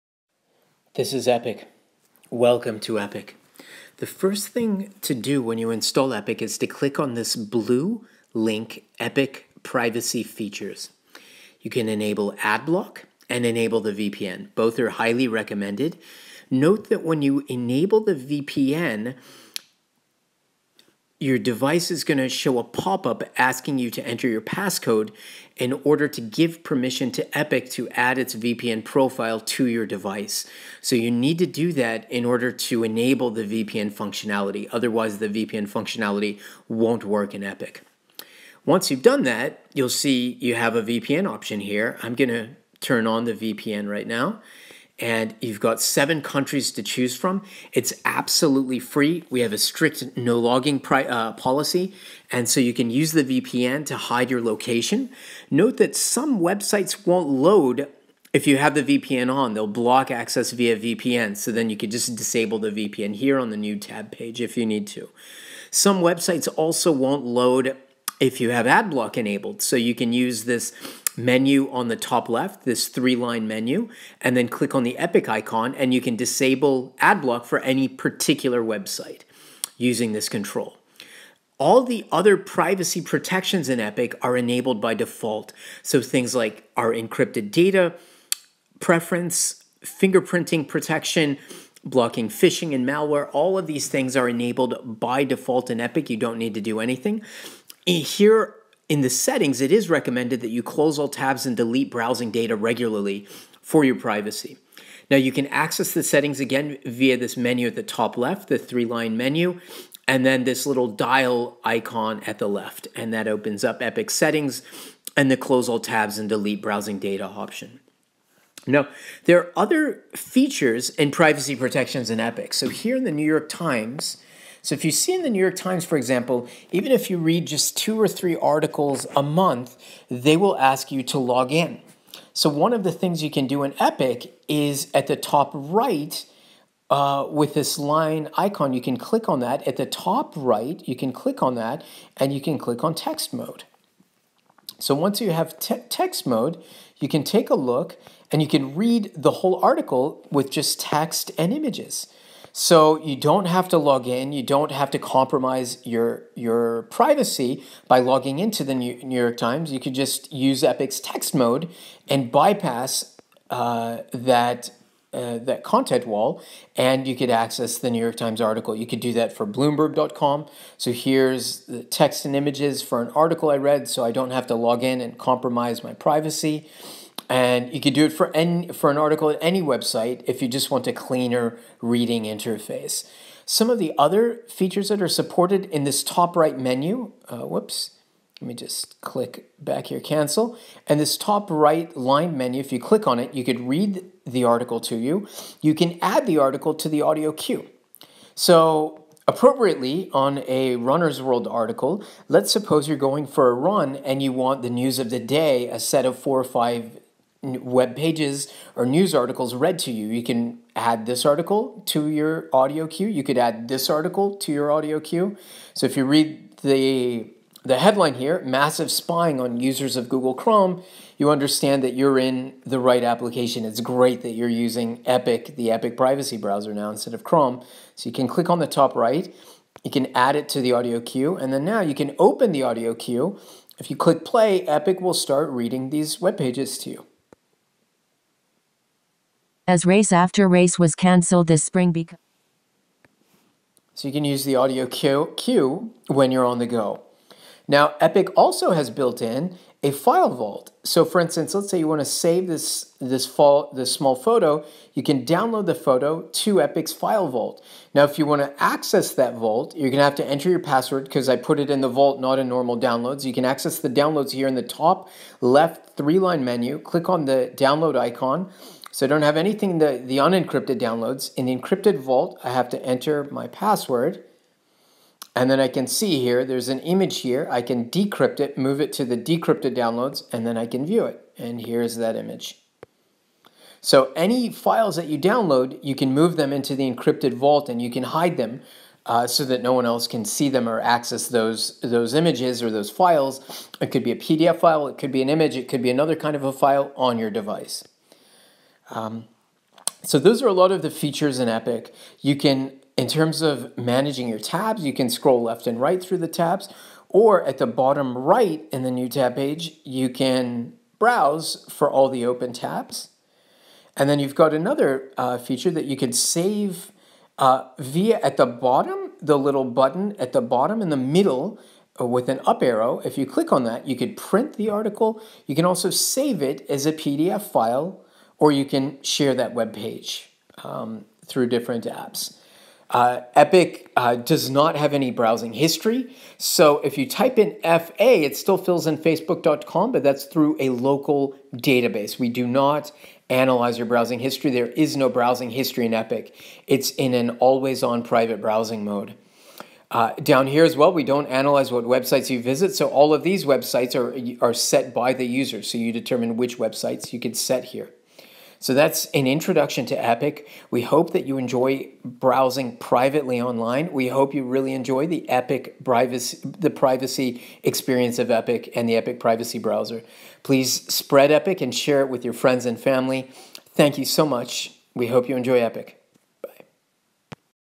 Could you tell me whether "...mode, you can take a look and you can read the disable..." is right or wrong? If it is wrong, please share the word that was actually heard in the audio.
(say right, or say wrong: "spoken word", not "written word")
wrong: "whole", not "disable".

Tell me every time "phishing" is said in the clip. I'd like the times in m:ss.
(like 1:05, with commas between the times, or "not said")
1:32.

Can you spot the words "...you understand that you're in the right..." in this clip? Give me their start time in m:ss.
3:41.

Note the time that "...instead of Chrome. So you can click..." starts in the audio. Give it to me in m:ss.
3:46.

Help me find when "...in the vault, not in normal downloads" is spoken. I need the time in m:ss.
4:21.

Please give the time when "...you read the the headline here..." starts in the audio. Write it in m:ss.
3:35.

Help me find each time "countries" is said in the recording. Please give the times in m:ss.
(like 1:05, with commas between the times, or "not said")
0:46.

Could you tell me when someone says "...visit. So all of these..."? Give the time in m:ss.
5:52.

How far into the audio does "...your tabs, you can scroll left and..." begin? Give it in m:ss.
5:04.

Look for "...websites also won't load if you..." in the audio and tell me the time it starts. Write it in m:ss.
1:06.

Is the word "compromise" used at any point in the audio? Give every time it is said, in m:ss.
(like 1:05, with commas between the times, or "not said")
2:34, 2:55.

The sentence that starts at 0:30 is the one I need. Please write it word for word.
So you need to do that in order to enable the VPN functionality.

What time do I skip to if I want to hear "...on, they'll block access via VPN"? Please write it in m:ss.
0:59.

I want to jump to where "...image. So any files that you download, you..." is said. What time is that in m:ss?
4:42.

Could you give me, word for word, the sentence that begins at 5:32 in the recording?
Uh, Epic uh, does not have any browsing history.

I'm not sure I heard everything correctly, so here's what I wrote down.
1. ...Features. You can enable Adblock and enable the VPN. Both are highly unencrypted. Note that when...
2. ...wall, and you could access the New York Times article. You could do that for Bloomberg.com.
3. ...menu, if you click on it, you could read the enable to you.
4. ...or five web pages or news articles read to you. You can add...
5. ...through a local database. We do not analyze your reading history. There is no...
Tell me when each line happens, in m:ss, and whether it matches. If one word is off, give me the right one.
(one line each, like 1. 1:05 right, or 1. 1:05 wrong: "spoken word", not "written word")
1. 0:10 wrong: "recommended", not "unencrypted"
2. 2:46 right
3. 3:12 wrong: "article", not "enable"
4. 3:26 right
5. 5:40 wrong: "browsing", not "reading".